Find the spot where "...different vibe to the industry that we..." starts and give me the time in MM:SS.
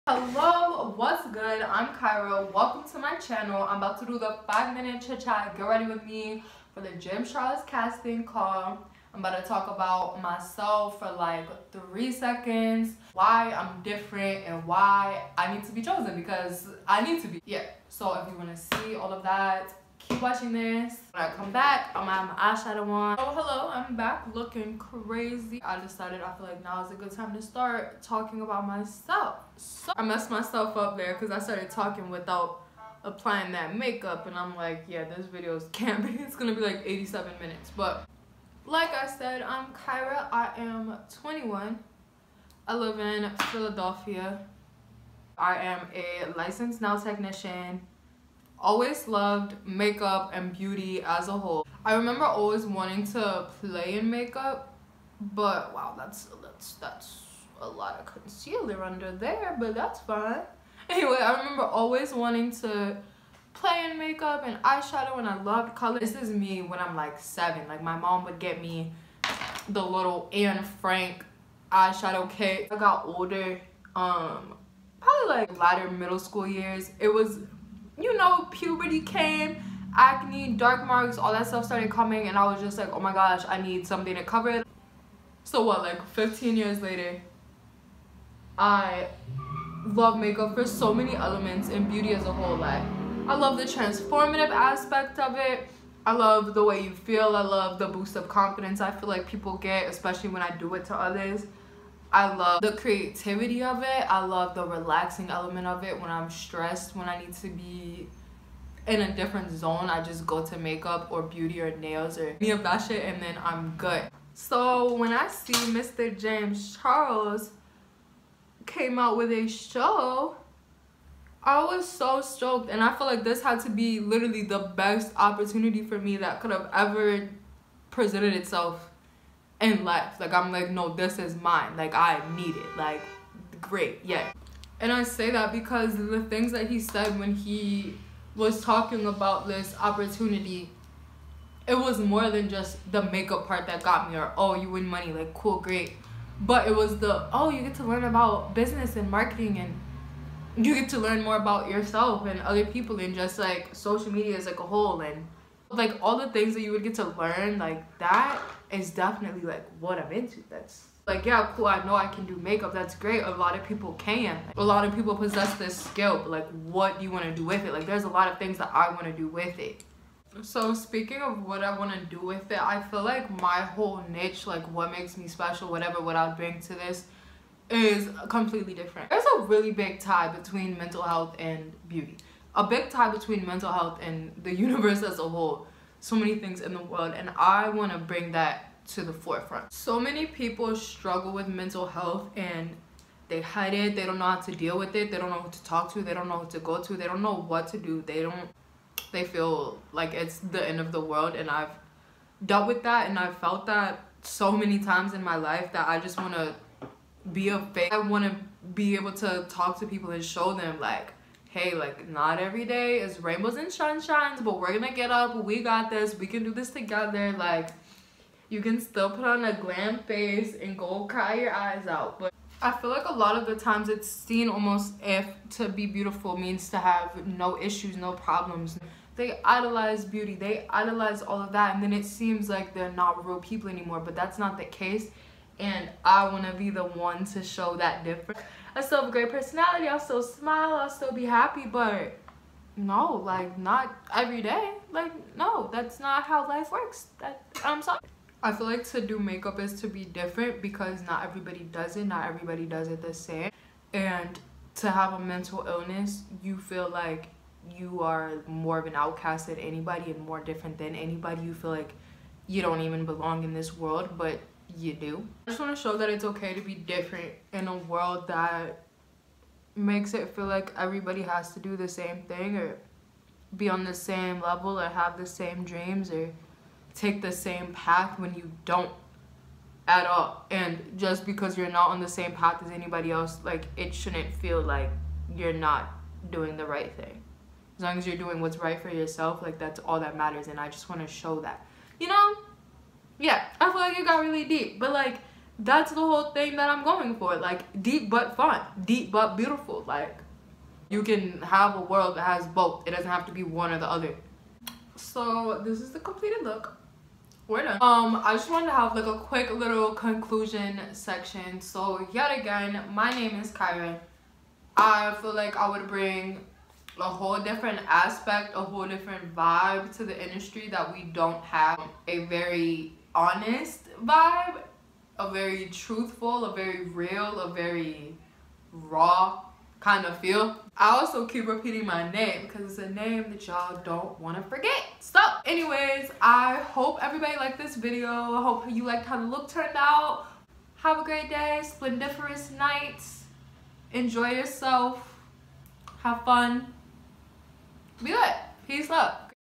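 05:18.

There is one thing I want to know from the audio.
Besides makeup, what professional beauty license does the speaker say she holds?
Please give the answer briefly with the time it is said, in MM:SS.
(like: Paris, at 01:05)
Nail technician, at 00:46.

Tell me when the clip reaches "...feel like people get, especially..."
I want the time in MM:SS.
01:38.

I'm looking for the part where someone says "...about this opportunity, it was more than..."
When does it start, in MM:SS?
02:19.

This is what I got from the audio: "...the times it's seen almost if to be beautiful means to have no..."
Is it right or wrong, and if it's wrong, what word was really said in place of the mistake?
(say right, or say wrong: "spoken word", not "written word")
right.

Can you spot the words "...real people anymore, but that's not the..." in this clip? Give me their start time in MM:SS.
03:53.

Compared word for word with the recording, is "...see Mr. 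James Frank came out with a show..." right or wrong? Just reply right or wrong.
wrong.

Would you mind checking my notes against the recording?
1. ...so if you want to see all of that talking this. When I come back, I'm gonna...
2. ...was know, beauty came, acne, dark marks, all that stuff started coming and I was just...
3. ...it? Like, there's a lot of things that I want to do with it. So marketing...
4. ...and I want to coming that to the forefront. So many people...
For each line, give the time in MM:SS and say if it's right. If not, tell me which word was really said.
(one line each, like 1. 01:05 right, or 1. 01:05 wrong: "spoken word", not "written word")
1. 00:17 wrong: "watching", not "talking"
2. 01:17 wrong: "puberty", not "beauty"
3. 02:47 wrong: "speaking", not "marketing"
4. 03:07 wrong: "bring", not "coming".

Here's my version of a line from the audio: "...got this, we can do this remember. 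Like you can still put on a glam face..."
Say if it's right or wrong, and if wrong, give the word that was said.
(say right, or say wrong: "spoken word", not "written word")
wrong: "together", not "remember".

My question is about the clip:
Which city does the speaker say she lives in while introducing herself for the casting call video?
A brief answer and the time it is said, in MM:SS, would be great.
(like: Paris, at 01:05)
Philadelphia, at 00:43.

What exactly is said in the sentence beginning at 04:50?
And I just want to show that, you know?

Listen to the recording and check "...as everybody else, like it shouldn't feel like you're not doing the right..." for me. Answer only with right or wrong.
wrong.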